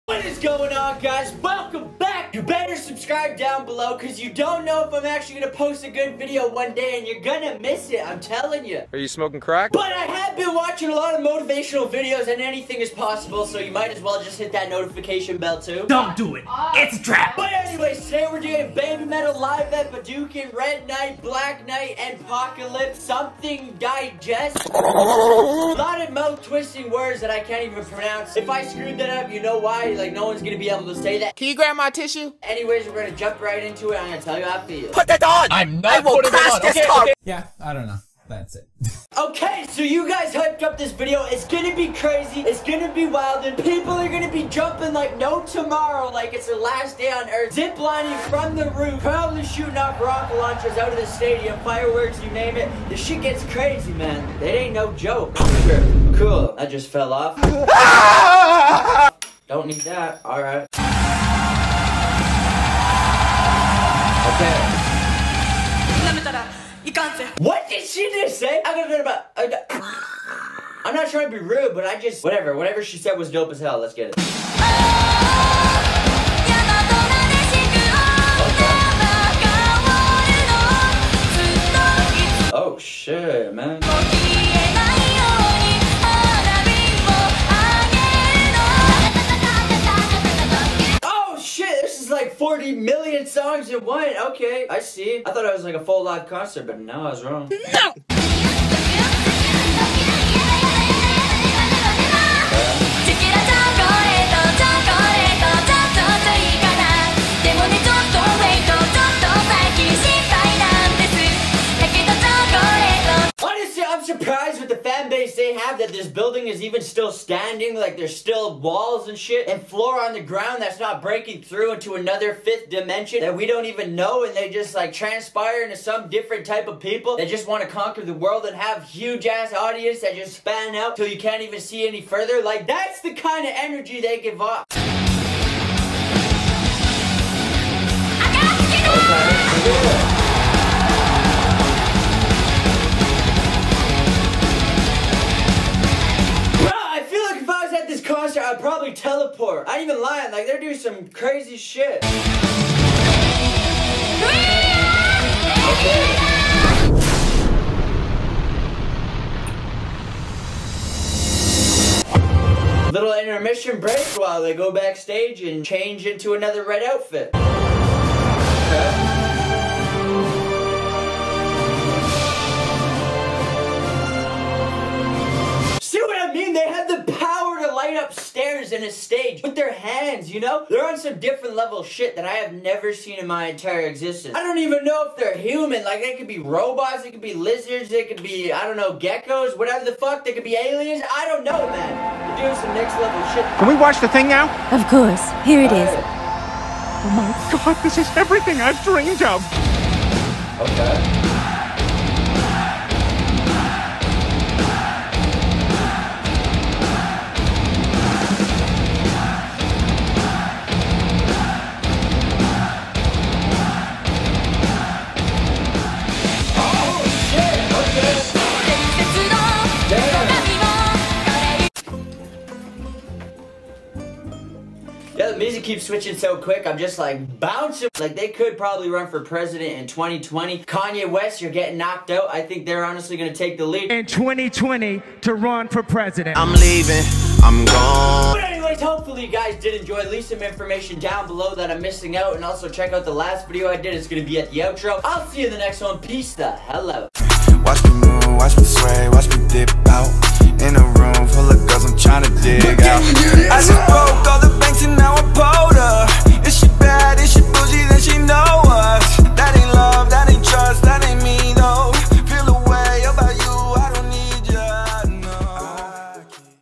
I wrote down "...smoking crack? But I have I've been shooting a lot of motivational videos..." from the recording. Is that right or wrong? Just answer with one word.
wrong.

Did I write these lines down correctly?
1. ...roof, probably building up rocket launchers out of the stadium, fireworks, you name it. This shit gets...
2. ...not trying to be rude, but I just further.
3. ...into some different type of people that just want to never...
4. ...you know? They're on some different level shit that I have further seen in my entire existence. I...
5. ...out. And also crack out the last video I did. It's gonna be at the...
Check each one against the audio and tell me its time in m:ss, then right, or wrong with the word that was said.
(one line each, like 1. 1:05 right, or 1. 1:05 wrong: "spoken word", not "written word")
1. 0:48 wrong: "shooting", not "building"
2. 1:10 wrong: "whatever", not "further"
3. 2:05 wrong: "conquer", not "never"
4. 3:00 wrong: "never", not "further"
5. 4:02 wrong: "check", not "crack".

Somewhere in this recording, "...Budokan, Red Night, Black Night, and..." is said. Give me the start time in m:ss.
0:19.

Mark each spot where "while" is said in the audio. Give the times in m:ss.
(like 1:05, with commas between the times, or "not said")
2:44.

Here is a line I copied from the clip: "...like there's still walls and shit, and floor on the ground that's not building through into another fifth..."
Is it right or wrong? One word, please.
wrong.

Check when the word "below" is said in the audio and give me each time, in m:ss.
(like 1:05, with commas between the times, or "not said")
0:03, 4:01.